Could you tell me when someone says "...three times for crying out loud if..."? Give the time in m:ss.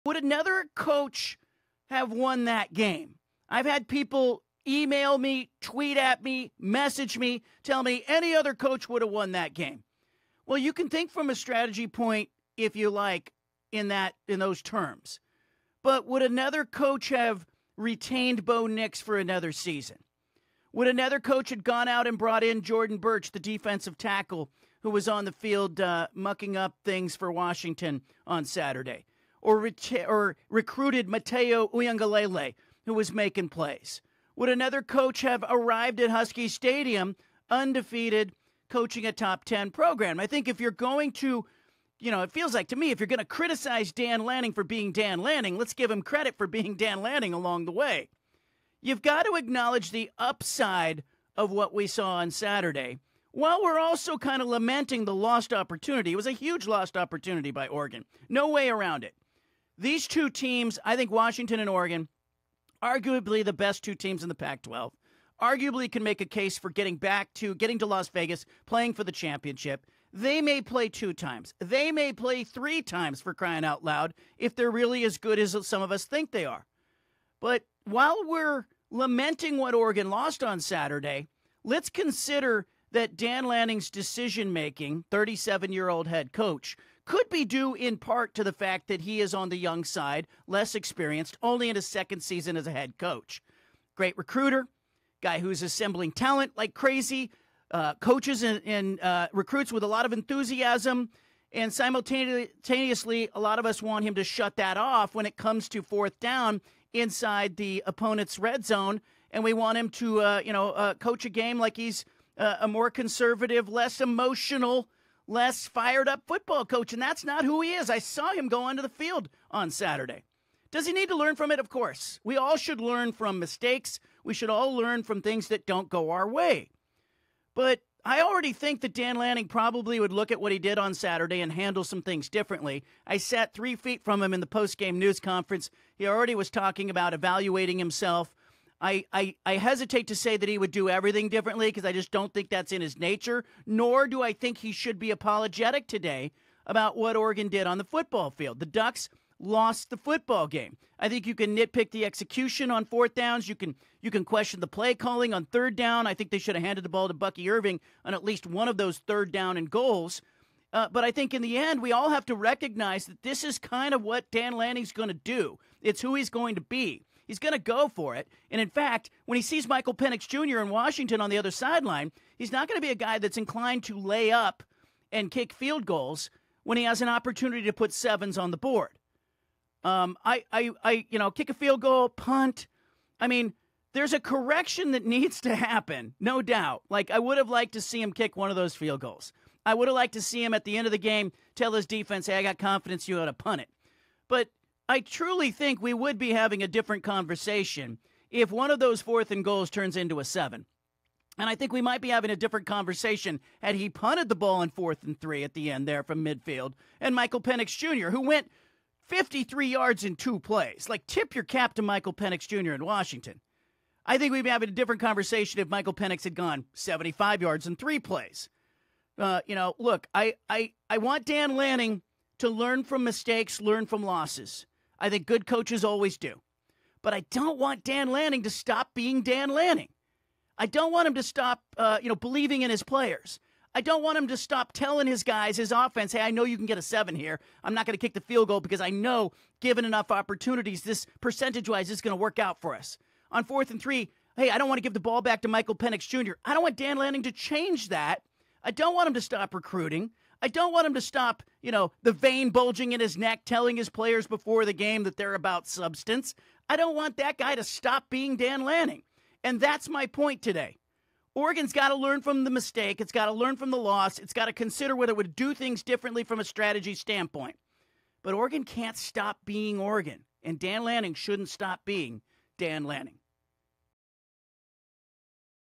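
1:12.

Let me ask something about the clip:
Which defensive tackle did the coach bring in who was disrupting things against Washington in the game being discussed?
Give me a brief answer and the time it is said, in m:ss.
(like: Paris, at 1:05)
Jordan Burch, at 0:22.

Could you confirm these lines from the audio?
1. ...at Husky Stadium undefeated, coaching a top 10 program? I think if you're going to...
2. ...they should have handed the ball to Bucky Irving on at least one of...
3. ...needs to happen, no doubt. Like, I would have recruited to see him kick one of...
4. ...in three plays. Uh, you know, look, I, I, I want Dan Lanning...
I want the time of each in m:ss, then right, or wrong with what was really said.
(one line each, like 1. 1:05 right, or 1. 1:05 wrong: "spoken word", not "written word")
1. 0:35 right
2. 2:36 right
3. 3:05 wrong: "liked", not "recruited"
4. 3:37 right.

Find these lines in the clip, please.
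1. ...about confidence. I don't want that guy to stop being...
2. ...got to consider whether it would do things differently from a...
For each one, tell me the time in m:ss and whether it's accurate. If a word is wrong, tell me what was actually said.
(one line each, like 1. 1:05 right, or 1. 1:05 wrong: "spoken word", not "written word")
1. 4:15 wrong: "substance", not "confidence"
2. 4:24 right.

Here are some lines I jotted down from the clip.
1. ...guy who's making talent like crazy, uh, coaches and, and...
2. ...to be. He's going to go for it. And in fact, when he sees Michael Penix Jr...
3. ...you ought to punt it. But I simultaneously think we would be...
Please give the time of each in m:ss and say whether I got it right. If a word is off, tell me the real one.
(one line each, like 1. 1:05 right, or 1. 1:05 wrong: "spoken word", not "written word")
1. 1:35 wrong: "assembling", not "making"
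2. 2:46 right
3. 3:13 wrong: "truly", not "simultaneously".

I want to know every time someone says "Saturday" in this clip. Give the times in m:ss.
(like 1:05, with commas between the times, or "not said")
0:28, 0:52, 1:20, 1:59, 2:10.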